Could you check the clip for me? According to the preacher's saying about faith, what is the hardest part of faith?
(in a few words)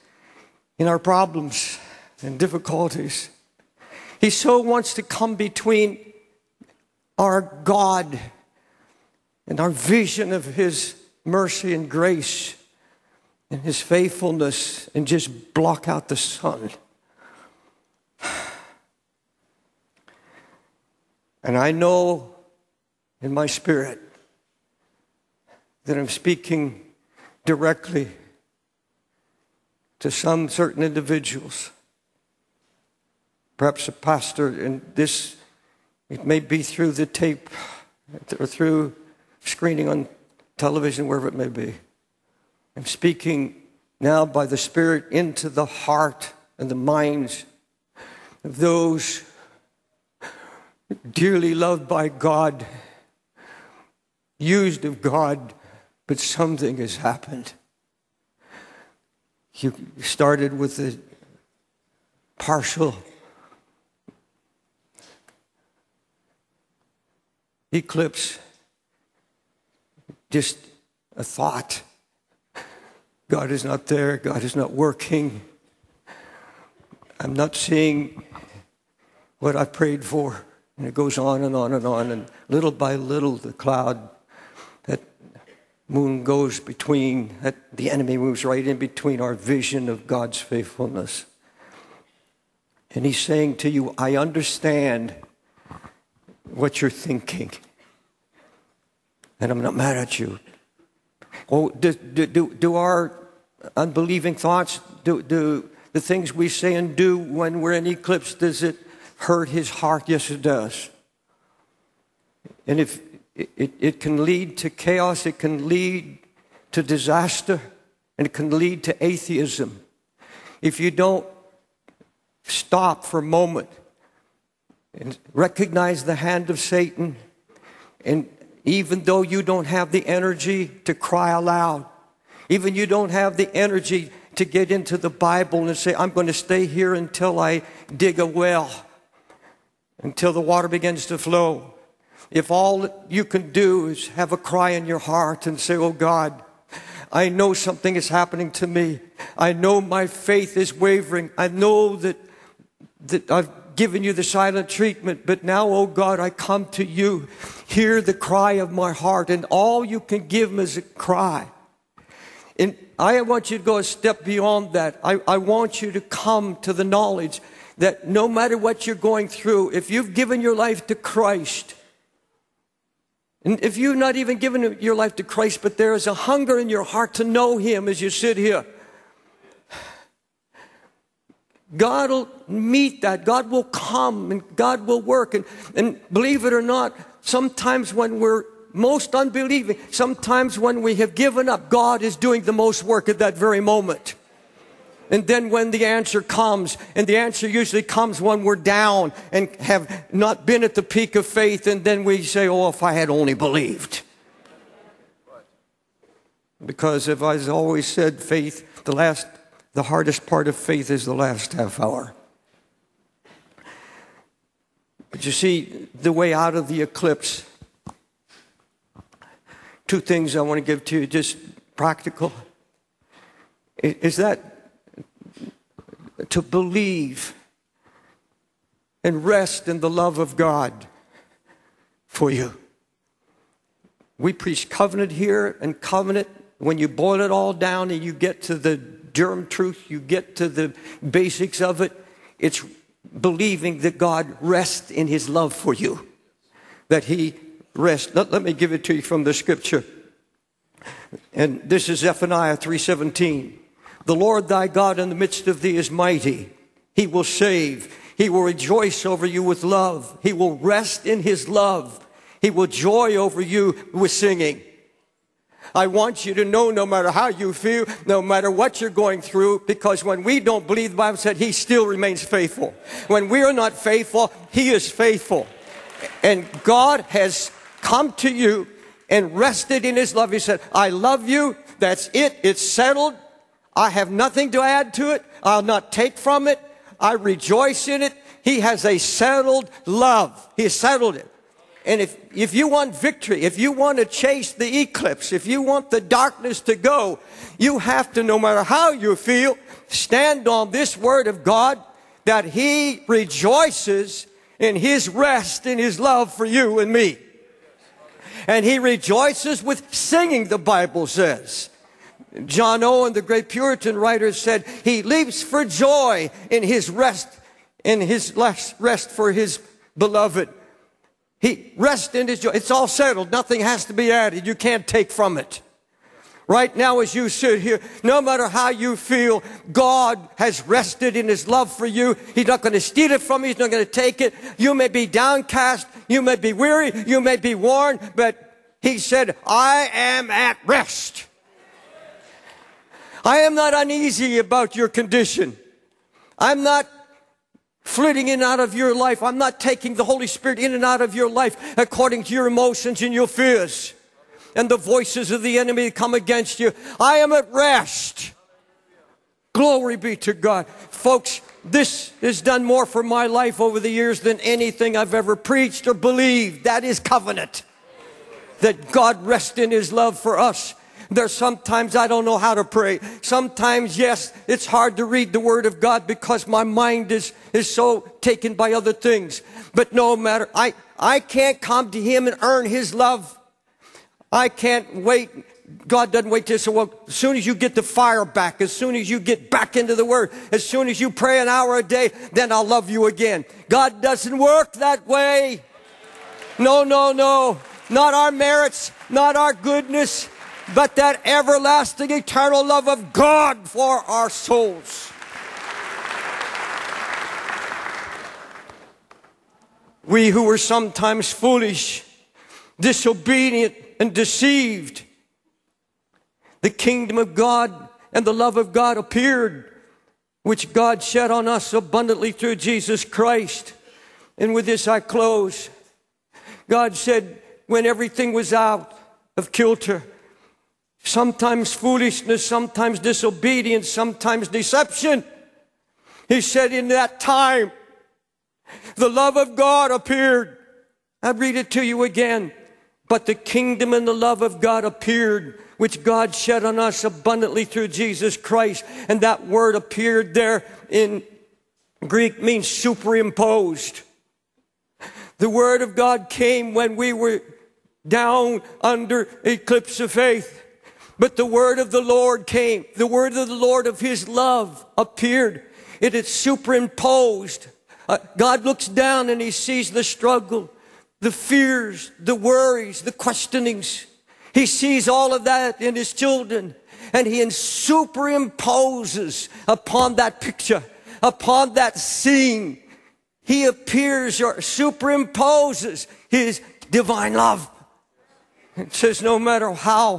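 The last half hour.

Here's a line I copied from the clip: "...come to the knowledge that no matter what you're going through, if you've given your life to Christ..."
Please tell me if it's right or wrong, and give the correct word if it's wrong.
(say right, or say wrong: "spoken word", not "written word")
right.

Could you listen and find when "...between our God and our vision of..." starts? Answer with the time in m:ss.
0:05.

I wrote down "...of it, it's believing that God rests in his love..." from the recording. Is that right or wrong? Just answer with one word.
right.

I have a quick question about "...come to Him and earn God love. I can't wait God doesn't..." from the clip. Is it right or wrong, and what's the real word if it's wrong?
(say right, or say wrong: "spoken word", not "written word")
wrong: "His", not "God".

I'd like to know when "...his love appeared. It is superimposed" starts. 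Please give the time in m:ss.
7:43.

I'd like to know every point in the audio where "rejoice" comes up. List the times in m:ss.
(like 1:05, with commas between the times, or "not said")
4:18, 4:47, 5:03, 5:08.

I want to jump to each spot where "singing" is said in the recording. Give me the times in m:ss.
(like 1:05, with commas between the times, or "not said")
4:24, 5:09.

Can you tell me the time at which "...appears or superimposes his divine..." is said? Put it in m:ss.
8:03.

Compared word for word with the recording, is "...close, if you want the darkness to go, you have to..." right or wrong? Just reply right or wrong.
wrong.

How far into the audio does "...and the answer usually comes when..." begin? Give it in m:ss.
3:16.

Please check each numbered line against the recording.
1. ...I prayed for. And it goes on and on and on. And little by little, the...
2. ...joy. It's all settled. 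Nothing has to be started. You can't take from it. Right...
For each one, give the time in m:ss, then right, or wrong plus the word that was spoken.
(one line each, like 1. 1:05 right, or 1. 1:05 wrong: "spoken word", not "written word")
1. 1:19 right
2. 5:22 wrong: "added", not "started".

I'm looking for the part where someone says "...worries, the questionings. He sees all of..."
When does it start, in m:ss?
7:52.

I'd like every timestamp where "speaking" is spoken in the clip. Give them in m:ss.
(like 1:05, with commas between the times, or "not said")
0:26, 0:42.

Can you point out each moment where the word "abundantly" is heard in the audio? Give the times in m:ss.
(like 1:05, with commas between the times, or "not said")
7:01, 7:27.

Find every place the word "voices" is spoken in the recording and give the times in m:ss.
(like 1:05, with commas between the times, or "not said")
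5:54.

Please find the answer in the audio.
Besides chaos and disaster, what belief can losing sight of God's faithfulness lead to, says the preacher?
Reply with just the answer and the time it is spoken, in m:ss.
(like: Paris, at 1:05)
Atheism, at 1:59.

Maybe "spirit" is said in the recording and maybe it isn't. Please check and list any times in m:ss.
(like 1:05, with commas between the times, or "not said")
0:23, 0:44, 5:50.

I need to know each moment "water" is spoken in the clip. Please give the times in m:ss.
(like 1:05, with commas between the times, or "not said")
2:20.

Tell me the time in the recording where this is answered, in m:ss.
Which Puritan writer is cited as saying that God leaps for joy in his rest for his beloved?
5:12.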